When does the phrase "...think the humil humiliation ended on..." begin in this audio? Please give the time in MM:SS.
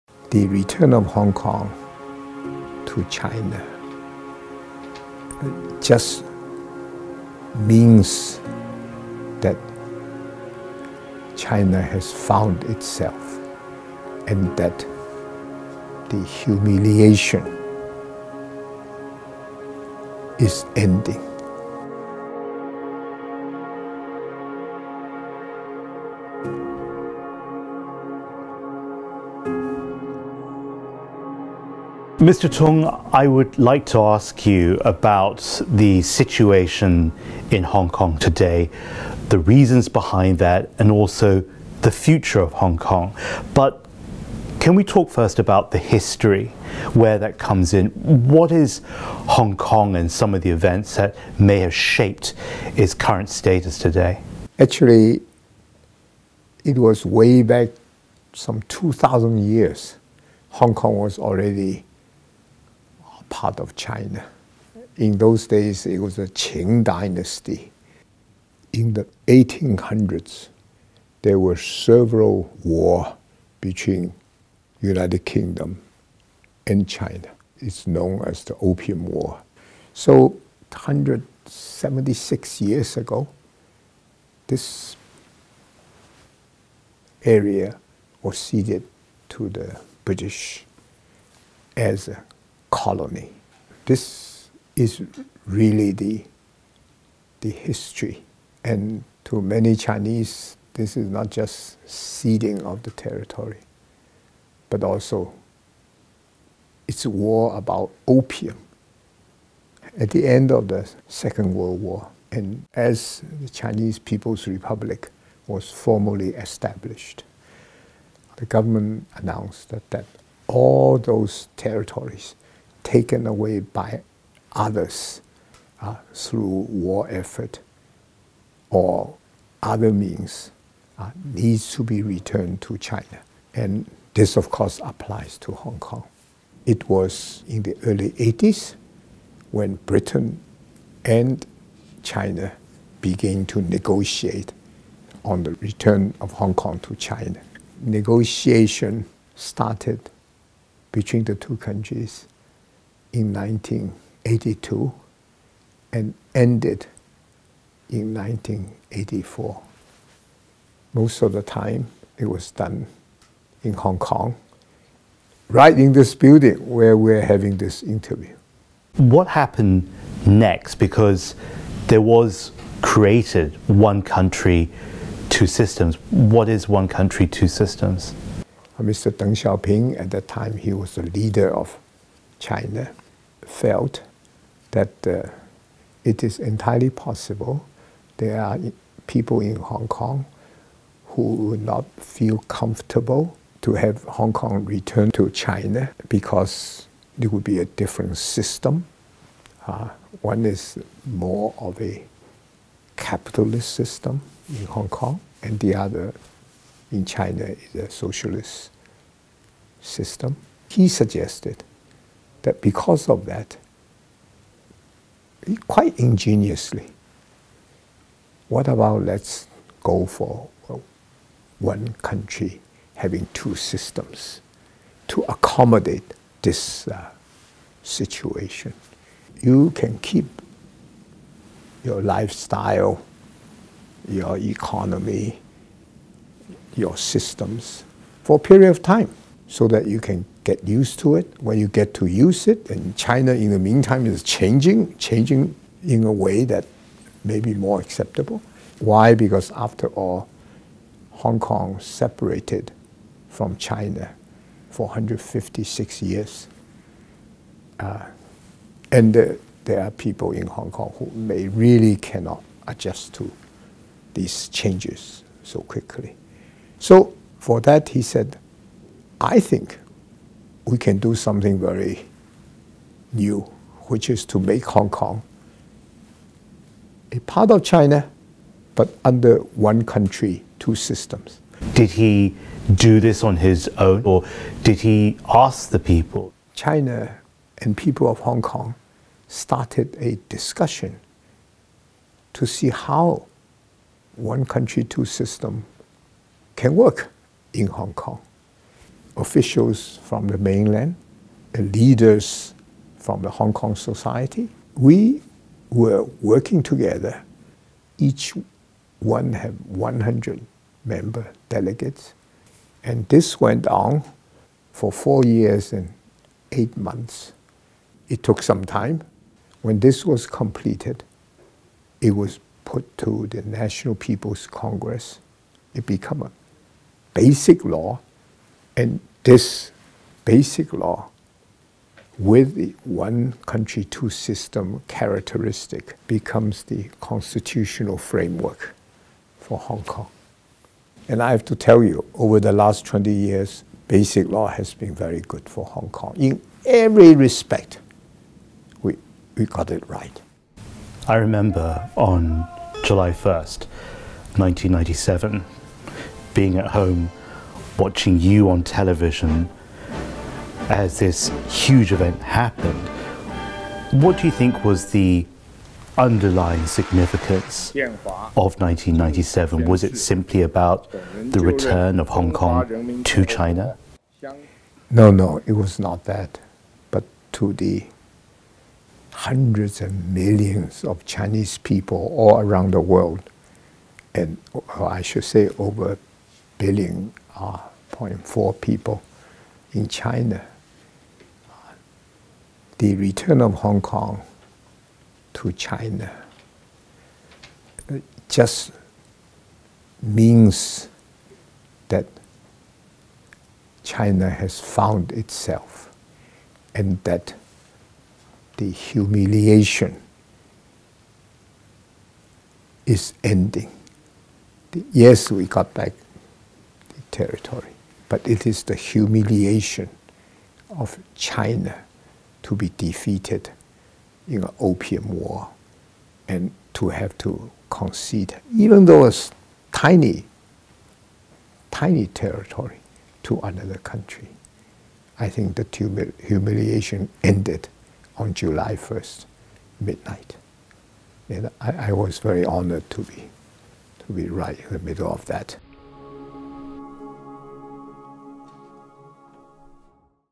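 07:15.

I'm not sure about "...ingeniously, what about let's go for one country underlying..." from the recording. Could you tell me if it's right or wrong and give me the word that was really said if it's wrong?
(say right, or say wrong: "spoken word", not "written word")
wrong: "having", not "underlying".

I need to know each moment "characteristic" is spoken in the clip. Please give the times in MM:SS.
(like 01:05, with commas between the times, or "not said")
05:34.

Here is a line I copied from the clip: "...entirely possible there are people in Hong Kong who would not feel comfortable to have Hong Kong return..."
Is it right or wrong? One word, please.
right.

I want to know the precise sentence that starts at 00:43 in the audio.
But can we talk first about the history, where that comes in?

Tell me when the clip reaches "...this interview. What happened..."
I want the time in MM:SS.
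02:47.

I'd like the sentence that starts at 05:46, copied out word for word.
In every respect, we, we got it right.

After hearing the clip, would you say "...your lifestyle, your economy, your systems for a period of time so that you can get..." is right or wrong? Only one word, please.
right.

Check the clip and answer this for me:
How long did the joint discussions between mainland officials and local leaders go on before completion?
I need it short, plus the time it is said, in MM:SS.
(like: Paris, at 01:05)
4 years and 8 months, at 05:14.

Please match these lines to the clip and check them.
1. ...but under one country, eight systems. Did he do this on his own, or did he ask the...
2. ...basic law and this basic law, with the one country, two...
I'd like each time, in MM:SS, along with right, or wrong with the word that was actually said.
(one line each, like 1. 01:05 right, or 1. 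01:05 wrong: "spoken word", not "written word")
1. 04:38 wrong: "two", not "eight"
2. 05:27 right.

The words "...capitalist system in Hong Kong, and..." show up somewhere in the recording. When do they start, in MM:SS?
03:22.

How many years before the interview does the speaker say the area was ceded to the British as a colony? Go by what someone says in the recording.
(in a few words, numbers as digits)
176 years.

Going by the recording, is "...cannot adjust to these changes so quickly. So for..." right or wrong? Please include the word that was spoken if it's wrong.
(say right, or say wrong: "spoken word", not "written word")
right.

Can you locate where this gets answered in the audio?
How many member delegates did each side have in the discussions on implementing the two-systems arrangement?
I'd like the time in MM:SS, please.
05:09.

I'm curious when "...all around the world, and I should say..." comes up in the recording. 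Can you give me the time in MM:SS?
06:22.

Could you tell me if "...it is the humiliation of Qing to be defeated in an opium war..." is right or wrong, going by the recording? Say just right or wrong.
wrong.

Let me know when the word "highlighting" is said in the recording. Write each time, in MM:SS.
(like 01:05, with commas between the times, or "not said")
not said.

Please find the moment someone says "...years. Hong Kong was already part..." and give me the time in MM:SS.
00:59.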